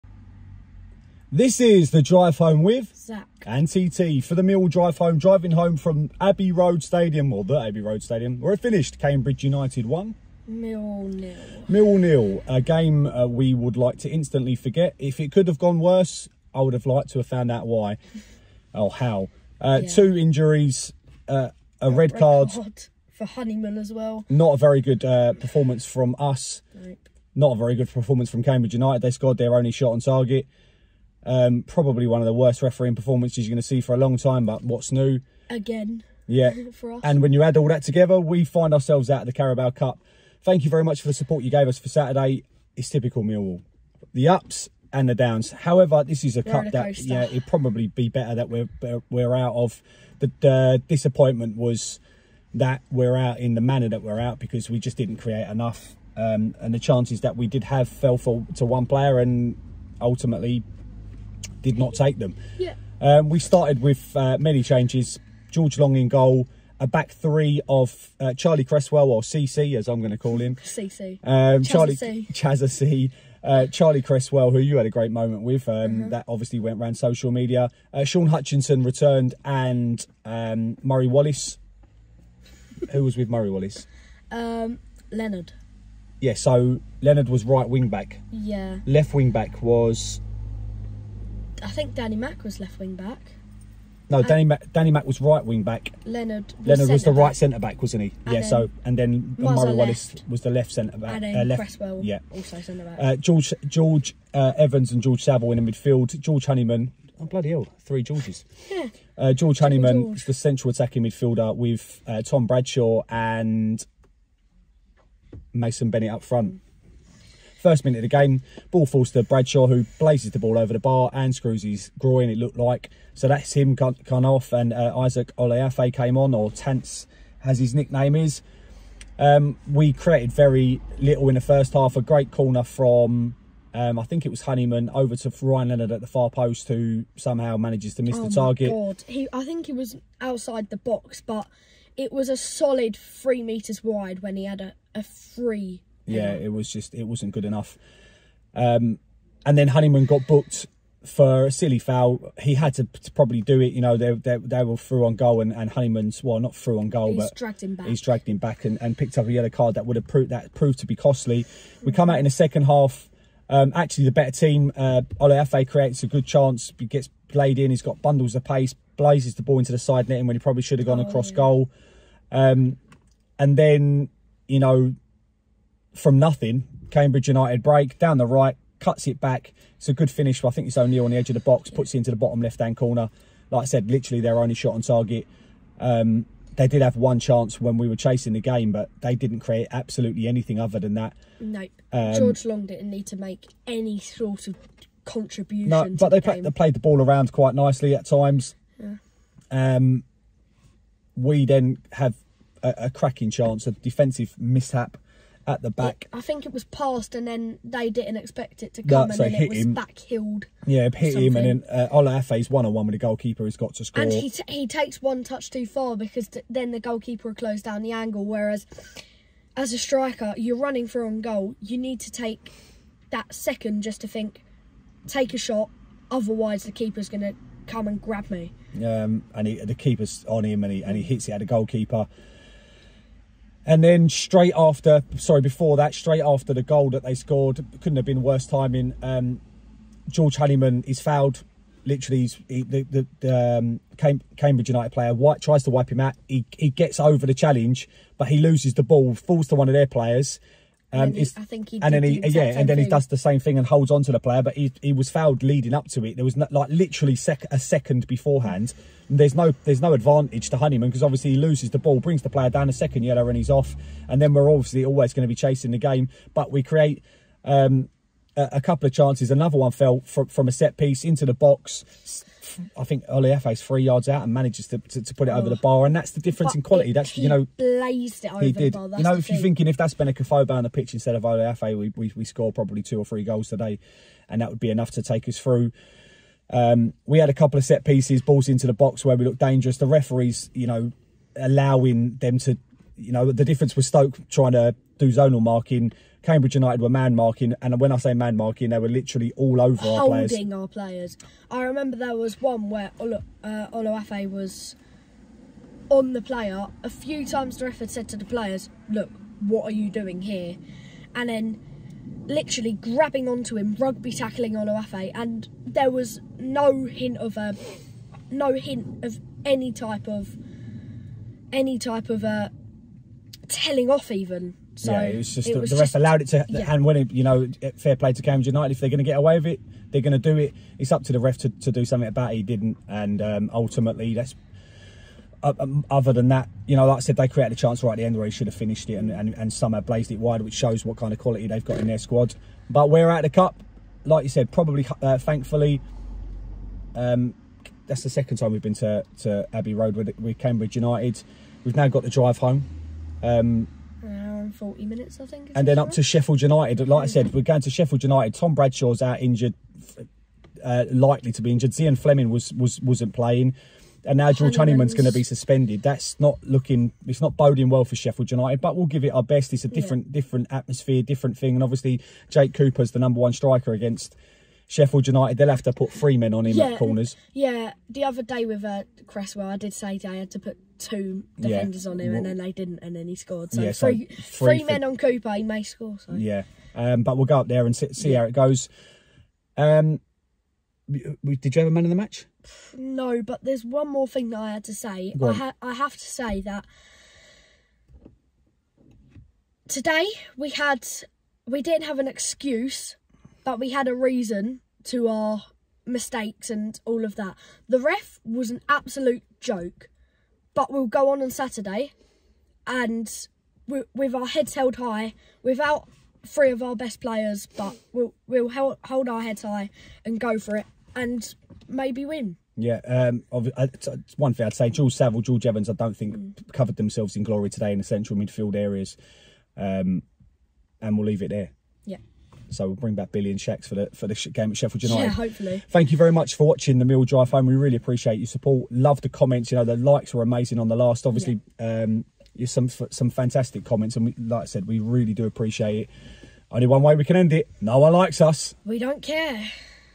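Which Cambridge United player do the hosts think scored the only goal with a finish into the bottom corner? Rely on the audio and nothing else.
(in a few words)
O'Neill.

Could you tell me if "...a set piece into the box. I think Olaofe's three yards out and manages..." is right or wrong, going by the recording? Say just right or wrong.
right.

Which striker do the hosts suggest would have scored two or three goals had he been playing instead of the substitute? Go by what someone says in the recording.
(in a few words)
Benik Afobe.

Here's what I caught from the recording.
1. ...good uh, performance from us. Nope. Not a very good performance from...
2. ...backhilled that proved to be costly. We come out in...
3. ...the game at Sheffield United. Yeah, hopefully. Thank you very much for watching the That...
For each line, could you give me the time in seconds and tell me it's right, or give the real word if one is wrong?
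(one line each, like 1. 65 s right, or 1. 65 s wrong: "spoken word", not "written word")
1. 24 s right
2. 160 s wrong: "proved", not "backhilled"
3. 434 s wrong: "Mill", not "That".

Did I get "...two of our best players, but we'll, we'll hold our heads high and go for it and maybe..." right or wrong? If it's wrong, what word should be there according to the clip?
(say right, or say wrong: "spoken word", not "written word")
wrong: "three", not "two".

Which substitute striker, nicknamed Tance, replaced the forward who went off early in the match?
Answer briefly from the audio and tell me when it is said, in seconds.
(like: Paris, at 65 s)
Isaac Olaofe, at 124 s.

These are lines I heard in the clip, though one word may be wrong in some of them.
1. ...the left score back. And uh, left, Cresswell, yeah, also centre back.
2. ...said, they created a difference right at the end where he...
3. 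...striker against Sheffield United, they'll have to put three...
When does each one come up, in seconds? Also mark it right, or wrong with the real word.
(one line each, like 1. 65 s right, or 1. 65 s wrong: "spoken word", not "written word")
1. 100 s wrong: "centre", not "score"
2. 337 s wrong: "chance", not "difference"
3. 373 s right.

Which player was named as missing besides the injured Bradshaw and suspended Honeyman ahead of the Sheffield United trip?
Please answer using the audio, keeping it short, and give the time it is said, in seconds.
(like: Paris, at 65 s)
Zian Flemming, at 361 s.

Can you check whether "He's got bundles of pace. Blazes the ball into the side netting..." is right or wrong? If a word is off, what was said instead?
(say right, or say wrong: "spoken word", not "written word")
right.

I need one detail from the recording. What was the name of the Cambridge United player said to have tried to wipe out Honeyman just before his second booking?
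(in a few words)
White.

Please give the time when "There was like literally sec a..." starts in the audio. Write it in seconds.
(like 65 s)
256 s.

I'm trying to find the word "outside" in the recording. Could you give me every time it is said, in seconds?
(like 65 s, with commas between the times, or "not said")
140 s.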